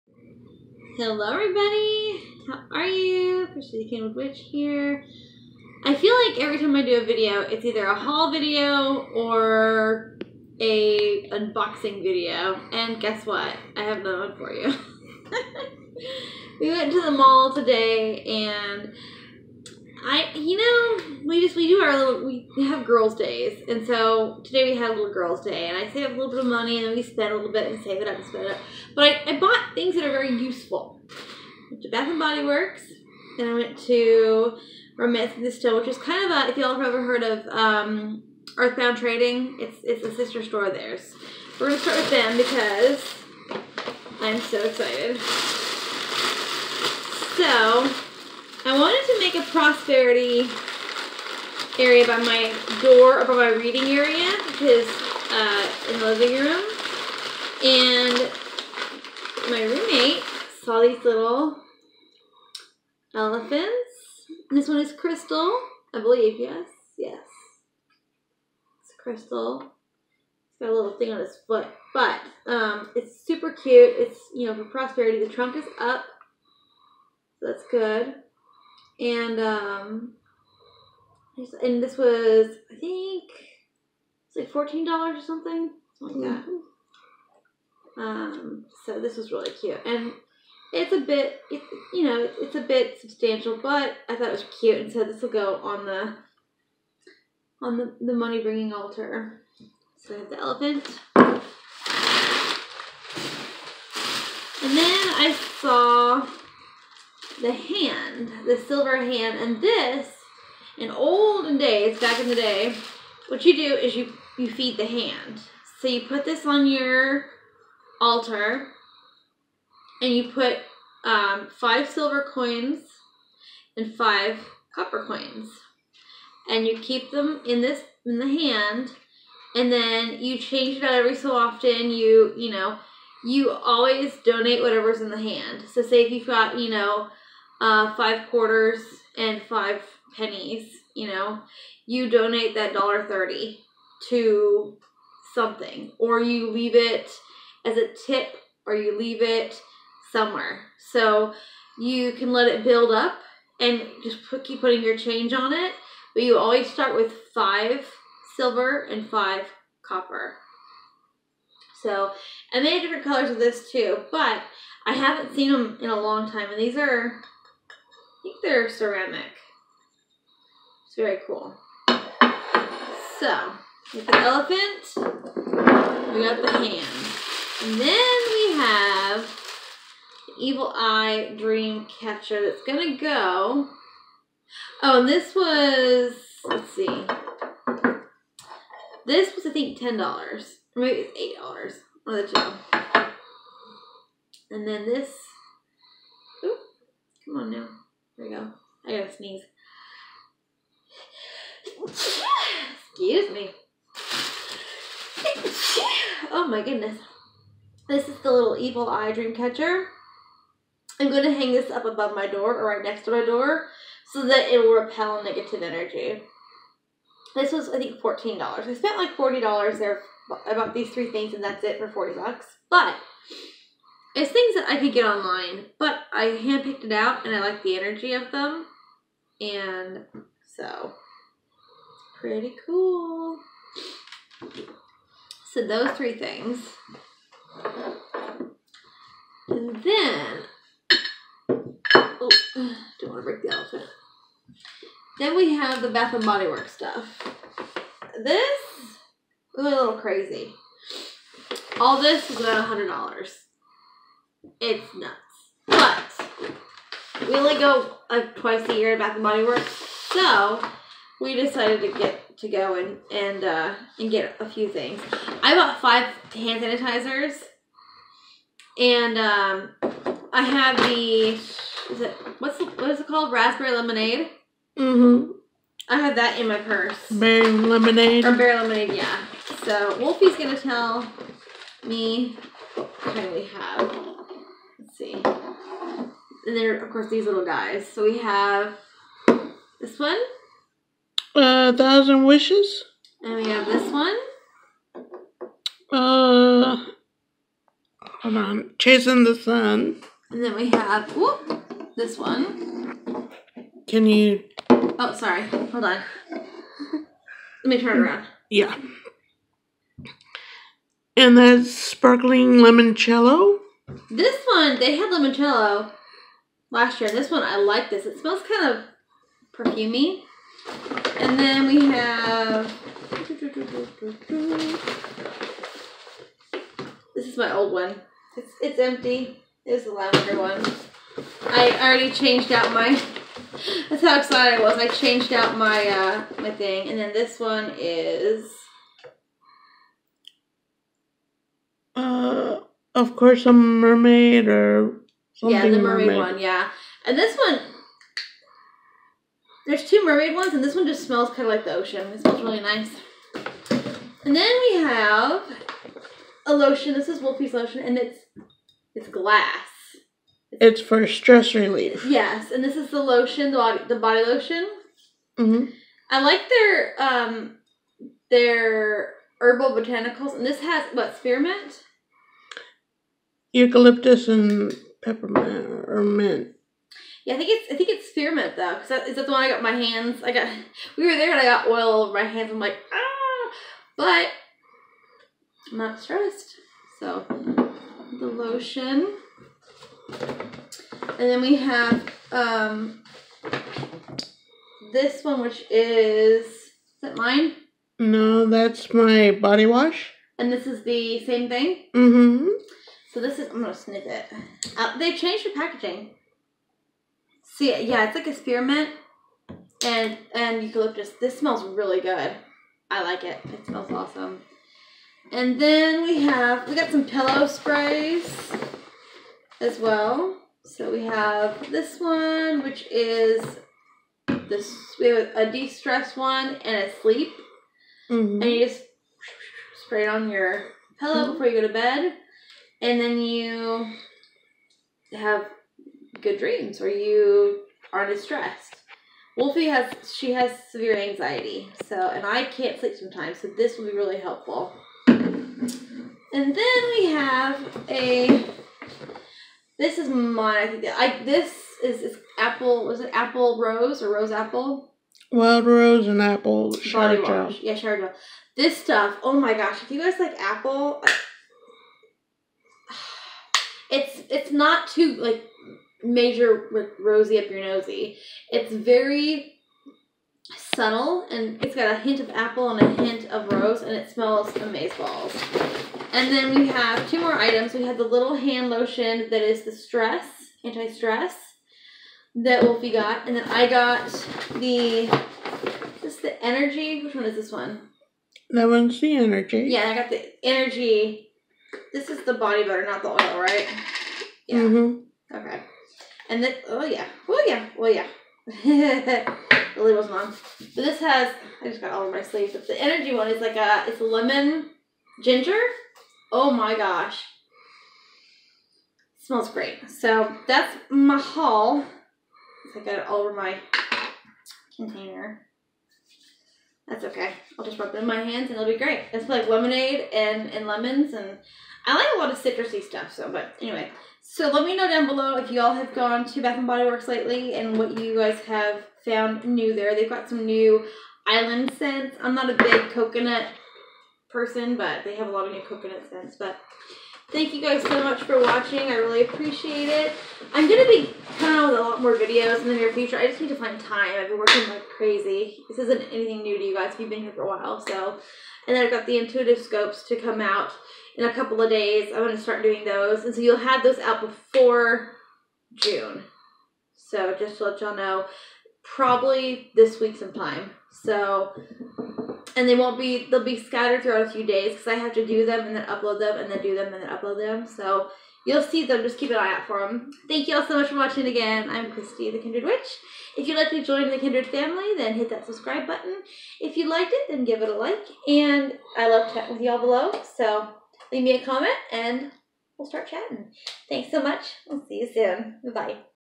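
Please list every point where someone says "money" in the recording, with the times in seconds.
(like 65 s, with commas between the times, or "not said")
26 s, 98 s.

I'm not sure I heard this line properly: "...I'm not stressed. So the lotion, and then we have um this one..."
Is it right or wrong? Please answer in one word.
right.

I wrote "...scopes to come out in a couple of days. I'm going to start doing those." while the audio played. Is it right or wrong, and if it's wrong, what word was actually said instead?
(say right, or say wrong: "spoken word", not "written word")
right.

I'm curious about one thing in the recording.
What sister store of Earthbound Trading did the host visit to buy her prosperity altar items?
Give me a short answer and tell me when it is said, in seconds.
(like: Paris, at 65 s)
Romancing the Stone, at 34 s.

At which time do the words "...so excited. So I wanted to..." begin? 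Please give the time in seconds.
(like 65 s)
44 s.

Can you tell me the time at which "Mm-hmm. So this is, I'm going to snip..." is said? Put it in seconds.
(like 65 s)
401 s.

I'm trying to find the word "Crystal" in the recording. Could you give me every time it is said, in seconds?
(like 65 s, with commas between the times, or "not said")
64 s, 69 s.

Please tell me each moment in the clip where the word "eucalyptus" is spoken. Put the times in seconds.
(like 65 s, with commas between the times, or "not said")
373 s, 410 s.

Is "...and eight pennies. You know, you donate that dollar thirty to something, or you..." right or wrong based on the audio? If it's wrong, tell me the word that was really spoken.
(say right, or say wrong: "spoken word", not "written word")
wrong: "five", not "eight".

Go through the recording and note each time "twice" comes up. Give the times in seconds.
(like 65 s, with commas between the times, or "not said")
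258 s.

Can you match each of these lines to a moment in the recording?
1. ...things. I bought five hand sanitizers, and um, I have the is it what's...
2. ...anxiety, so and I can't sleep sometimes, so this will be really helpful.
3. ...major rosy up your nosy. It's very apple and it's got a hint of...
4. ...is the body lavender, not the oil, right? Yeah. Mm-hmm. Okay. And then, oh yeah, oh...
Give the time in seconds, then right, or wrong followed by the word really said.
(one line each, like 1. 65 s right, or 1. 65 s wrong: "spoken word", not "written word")
1. 264 s right
2. 440 s right
3. 466 s wrong: "subtle", not "apple"
4. 492 s wrong: "butter", not "lavender".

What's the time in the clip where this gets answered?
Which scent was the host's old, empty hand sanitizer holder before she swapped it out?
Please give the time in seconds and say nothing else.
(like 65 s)
329 s.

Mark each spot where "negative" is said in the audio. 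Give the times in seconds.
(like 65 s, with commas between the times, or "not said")
215 s.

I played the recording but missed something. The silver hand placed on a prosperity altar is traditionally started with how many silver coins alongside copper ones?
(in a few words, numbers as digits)
5.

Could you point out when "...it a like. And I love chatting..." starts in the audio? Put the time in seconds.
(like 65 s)
577 s.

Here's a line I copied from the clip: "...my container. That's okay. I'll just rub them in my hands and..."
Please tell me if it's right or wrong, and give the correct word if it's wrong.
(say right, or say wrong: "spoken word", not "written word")
right.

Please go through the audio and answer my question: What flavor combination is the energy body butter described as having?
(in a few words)
Lemon ginger.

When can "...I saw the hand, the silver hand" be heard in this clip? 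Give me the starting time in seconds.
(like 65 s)
105 s.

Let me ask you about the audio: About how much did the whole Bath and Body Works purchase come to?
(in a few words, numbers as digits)
$100.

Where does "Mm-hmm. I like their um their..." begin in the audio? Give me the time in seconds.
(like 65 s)
365 s.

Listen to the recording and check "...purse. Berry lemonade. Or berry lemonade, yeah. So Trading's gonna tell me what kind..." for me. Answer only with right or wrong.
wrong.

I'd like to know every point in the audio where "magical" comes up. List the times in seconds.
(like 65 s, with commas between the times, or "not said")
not said.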